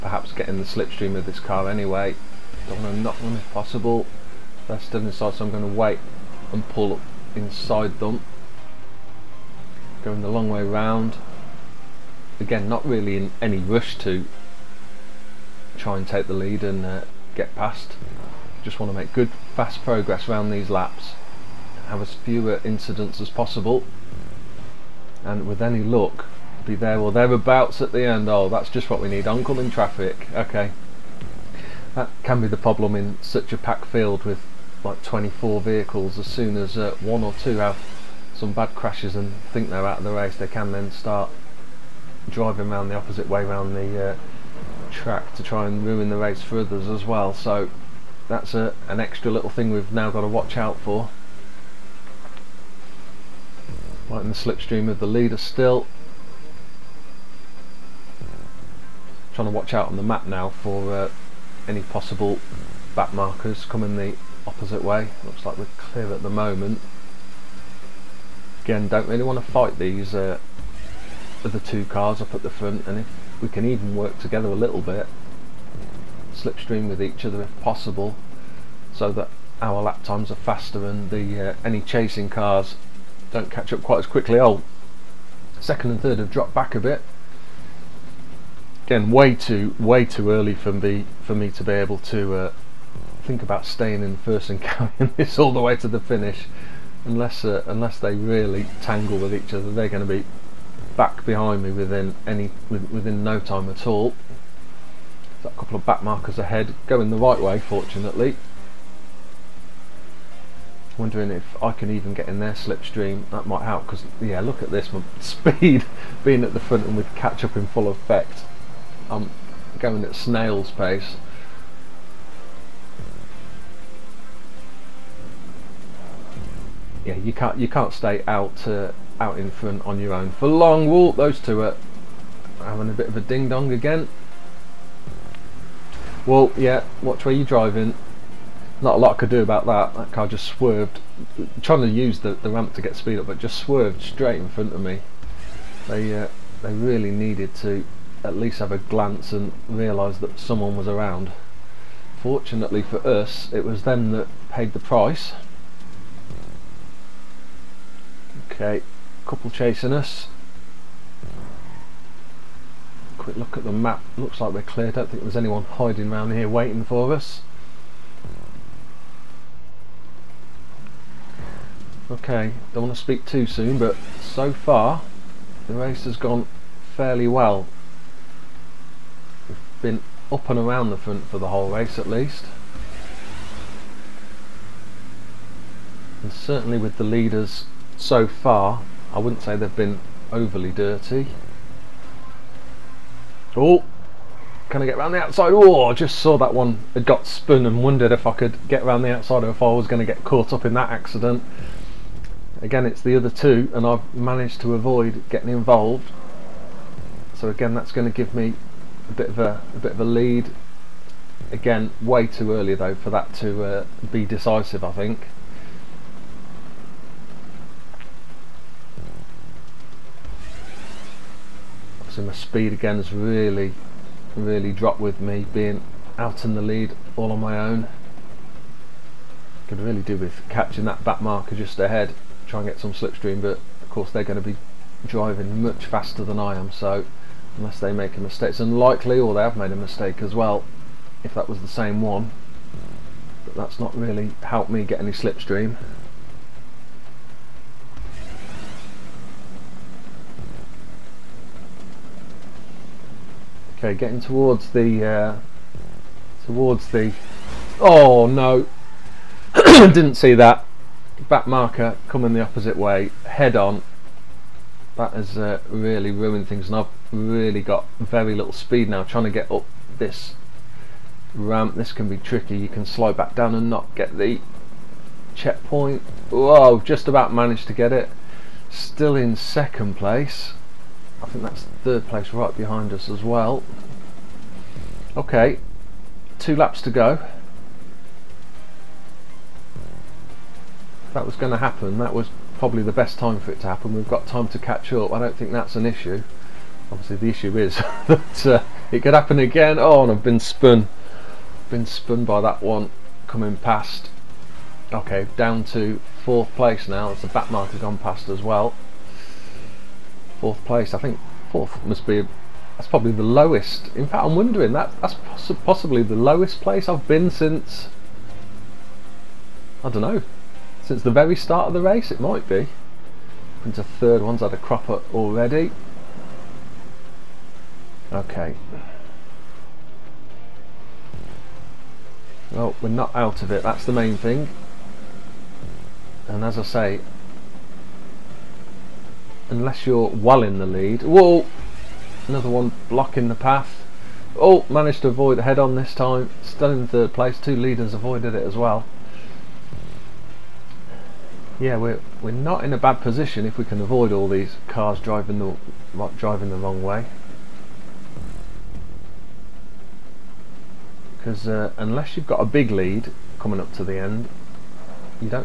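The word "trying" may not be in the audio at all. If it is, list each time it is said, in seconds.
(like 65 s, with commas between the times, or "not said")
59 s, 141 s, 269 s.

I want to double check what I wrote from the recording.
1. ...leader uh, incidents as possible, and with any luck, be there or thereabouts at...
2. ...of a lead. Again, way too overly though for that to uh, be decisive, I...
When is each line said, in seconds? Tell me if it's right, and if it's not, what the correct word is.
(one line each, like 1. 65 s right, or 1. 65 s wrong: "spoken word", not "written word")
1. 22 s wrong: "fewer", not "leader"
2. 209 s wrong: "early", not "overly".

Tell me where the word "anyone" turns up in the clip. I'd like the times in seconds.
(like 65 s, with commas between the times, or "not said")
165 s.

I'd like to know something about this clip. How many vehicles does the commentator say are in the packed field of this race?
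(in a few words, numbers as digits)
24.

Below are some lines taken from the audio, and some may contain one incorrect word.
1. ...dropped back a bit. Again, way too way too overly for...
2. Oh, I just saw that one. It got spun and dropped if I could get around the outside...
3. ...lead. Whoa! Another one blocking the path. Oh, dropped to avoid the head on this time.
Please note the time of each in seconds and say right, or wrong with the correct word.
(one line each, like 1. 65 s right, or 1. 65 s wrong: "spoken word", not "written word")
1. 86 s wrong: "early", not "overly"
2. 195 s wrong: "wondered", not "dropped"
3. 340 s wrong: "managed", not "dropped".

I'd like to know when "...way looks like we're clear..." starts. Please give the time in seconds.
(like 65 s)
64 s.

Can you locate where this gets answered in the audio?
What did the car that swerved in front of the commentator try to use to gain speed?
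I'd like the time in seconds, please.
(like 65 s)
142 s.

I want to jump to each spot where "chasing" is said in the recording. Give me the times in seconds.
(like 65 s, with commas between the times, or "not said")
81 s, 159 s.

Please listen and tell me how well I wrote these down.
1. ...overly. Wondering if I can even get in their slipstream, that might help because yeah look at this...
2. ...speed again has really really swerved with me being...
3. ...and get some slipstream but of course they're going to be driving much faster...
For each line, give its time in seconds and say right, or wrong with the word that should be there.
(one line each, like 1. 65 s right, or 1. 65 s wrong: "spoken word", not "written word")
1. 107 s wrong: "fortunately", not "overly"
2. 222 s wrong: "dropped", not "swerved"
3. 232 s right.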